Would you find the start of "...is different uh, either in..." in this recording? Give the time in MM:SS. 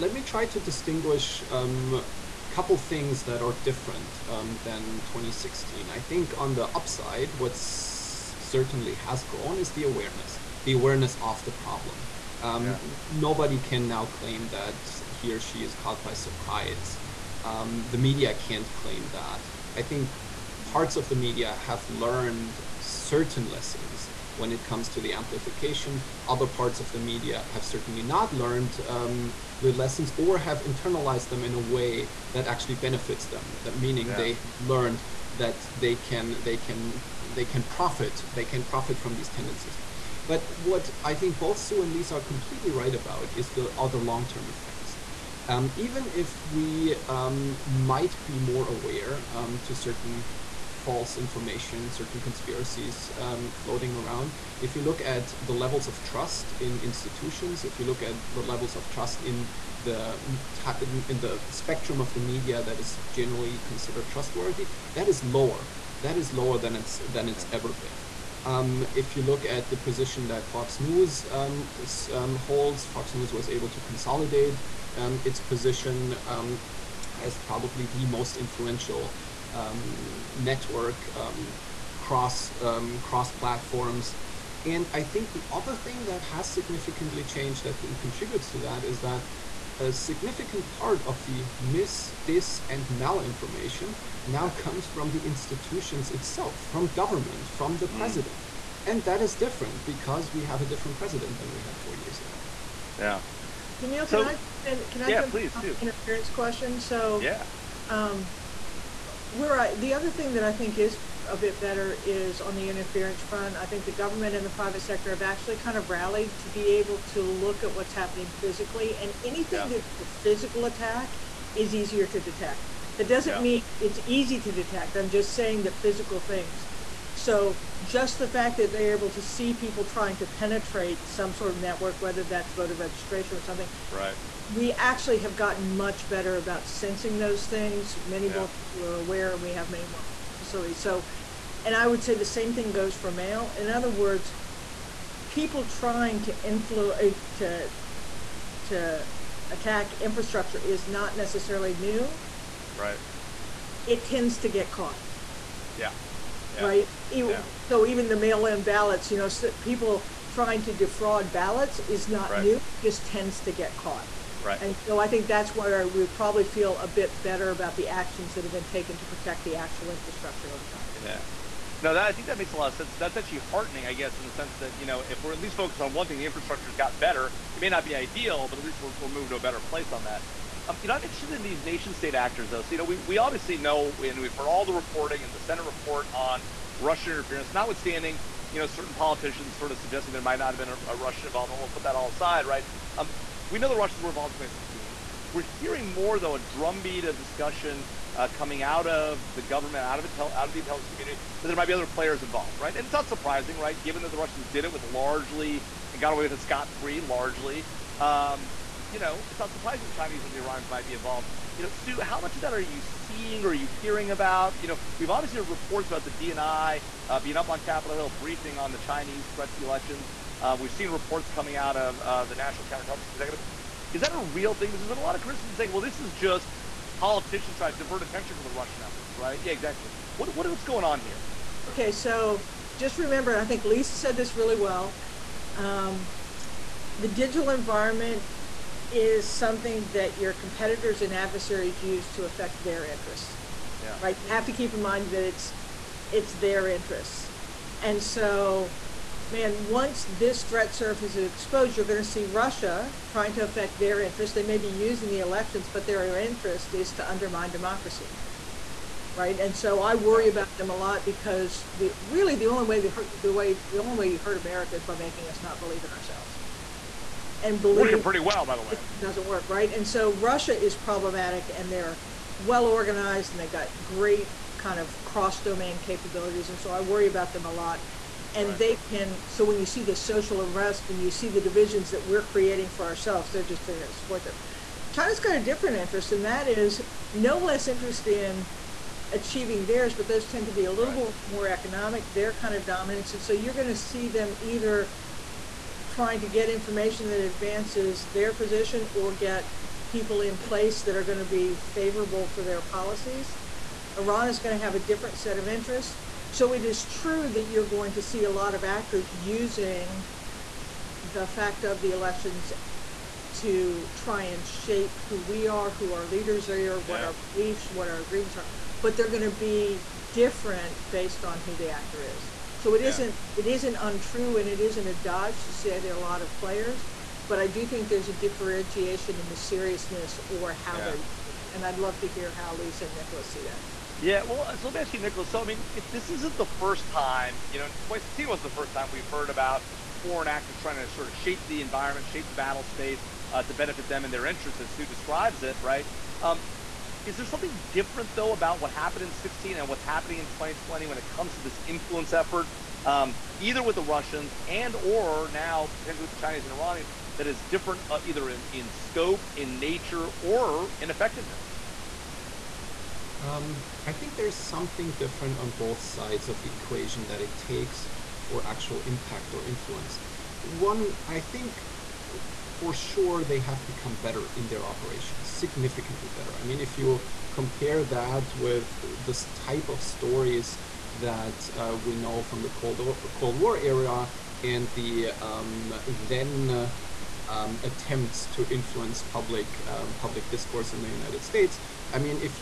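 05:57.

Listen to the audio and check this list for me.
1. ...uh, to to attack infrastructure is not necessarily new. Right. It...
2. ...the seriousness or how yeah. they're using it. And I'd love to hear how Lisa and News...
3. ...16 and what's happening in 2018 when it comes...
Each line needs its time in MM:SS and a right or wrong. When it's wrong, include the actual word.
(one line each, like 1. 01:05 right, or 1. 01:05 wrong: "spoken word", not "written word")
1. 02:27 right
2. 05:29 wrong: "Nikolas", not "News"
3. 05:49 wrong: "2020", not "2018".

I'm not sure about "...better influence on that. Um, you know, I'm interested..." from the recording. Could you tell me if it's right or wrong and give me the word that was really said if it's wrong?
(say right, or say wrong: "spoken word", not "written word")
wrong: "place", not "influence".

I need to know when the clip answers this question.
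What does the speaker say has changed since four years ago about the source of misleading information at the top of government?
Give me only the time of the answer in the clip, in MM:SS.
01:40.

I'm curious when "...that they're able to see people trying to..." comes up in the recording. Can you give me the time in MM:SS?
02:08.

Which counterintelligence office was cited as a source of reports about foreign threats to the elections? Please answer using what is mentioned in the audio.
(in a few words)
National Counterintelligence Executive.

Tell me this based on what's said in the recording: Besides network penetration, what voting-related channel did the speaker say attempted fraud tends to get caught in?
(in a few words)
mail-in ballots.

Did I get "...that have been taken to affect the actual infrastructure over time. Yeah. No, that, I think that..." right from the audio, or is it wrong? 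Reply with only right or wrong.
wrong.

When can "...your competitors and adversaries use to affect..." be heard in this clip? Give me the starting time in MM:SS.
04:00.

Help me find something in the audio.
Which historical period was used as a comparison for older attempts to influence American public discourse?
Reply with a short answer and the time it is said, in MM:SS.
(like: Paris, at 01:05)
Cold War era, at 06:23.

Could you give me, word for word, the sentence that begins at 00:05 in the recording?
I think on the upside, what's certainly has grown is the awareness, the awareness of the problem.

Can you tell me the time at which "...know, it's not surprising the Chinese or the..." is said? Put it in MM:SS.
03:28.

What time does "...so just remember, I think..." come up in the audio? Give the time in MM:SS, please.
03:51.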